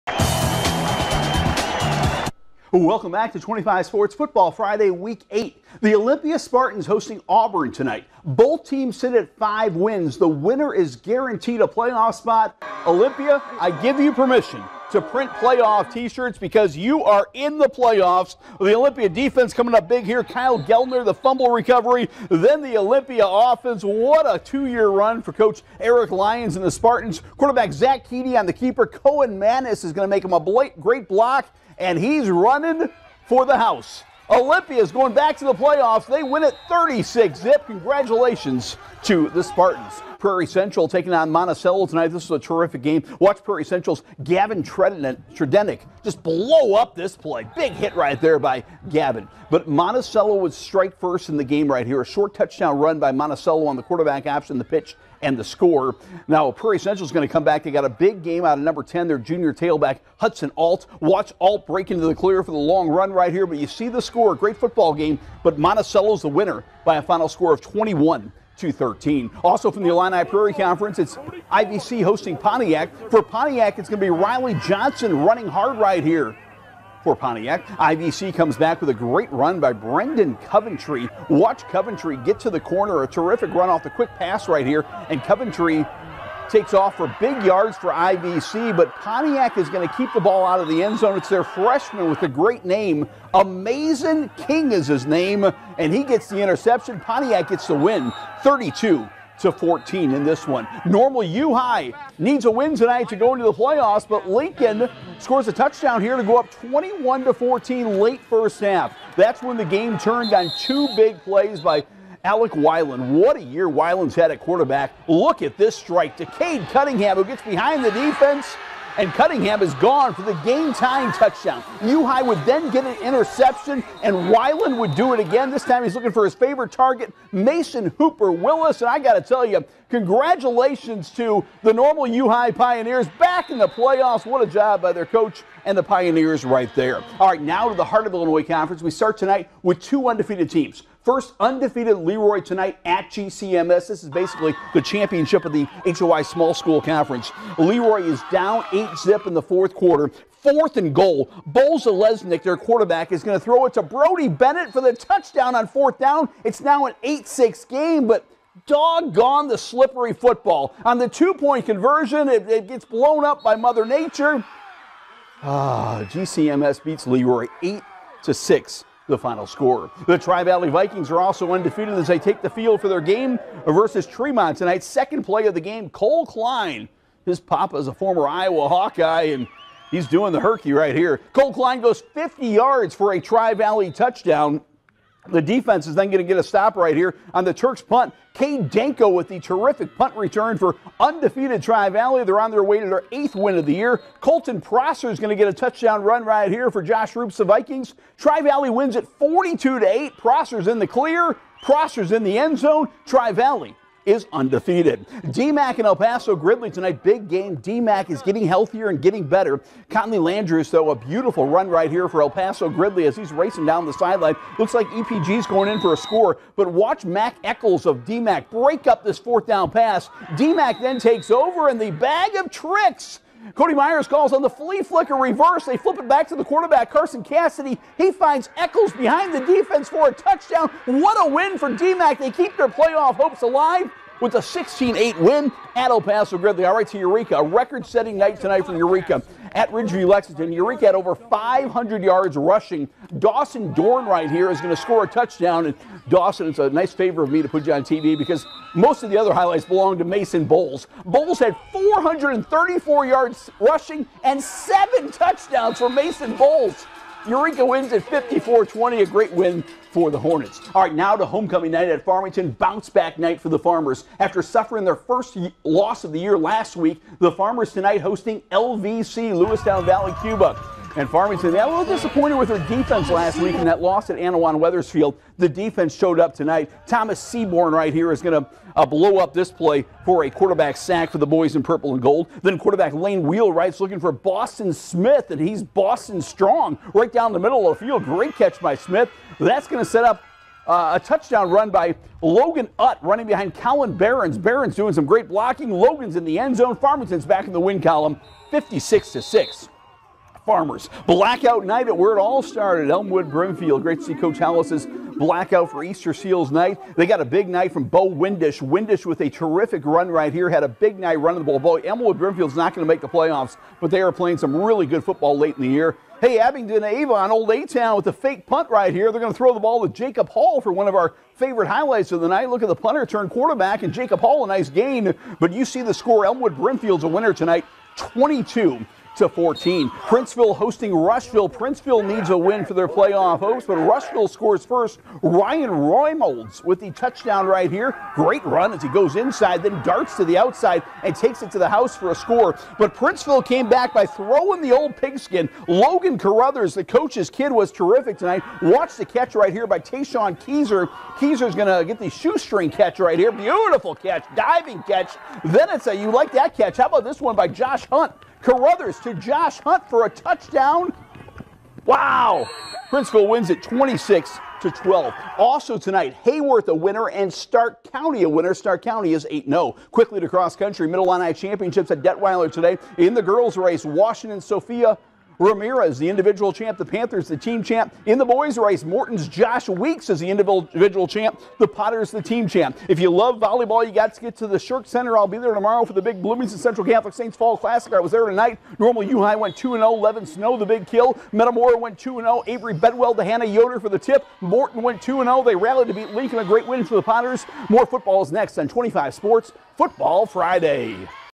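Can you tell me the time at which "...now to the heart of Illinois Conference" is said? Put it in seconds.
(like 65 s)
137 s.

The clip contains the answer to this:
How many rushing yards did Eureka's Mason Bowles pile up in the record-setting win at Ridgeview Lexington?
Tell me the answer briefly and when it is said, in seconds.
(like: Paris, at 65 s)
434, at 251 s.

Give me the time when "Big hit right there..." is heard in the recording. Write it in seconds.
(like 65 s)
47 s.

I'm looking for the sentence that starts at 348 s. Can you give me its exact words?
Watch the catch right here by Tayshawn Keezer.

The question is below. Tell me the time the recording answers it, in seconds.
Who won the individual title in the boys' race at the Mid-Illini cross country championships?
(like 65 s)
379 s.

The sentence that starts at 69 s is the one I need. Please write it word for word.
Also from the Illini Prairie Conference, it's IVC hosting Pontiac.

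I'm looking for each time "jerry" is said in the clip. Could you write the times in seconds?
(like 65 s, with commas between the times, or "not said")
not said.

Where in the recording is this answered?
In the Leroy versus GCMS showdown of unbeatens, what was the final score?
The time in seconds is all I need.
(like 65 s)
167 s.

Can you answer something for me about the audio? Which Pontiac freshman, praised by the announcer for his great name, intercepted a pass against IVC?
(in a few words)
Amazing King.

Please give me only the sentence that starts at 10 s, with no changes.
The winner is guaranteed a playoff spot.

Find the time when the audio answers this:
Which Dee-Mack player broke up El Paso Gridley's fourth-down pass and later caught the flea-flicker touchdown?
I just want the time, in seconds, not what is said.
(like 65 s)
217 s.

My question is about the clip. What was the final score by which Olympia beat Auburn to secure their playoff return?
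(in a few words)
36-0.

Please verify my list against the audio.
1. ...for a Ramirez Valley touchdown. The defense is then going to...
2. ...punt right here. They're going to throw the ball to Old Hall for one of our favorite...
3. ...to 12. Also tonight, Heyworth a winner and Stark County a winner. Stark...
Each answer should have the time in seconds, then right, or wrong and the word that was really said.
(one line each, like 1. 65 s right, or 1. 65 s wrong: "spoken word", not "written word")
1. 182 s wrong: "Tri", not "Ramirez"
2. 318 s wrong: "Jacob", not "Old"
3. 364 s right.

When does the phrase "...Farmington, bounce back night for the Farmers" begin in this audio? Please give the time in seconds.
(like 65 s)
262 s.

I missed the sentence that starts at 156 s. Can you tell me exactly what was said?
It's now an 8 6 game, but doggone the slippery football.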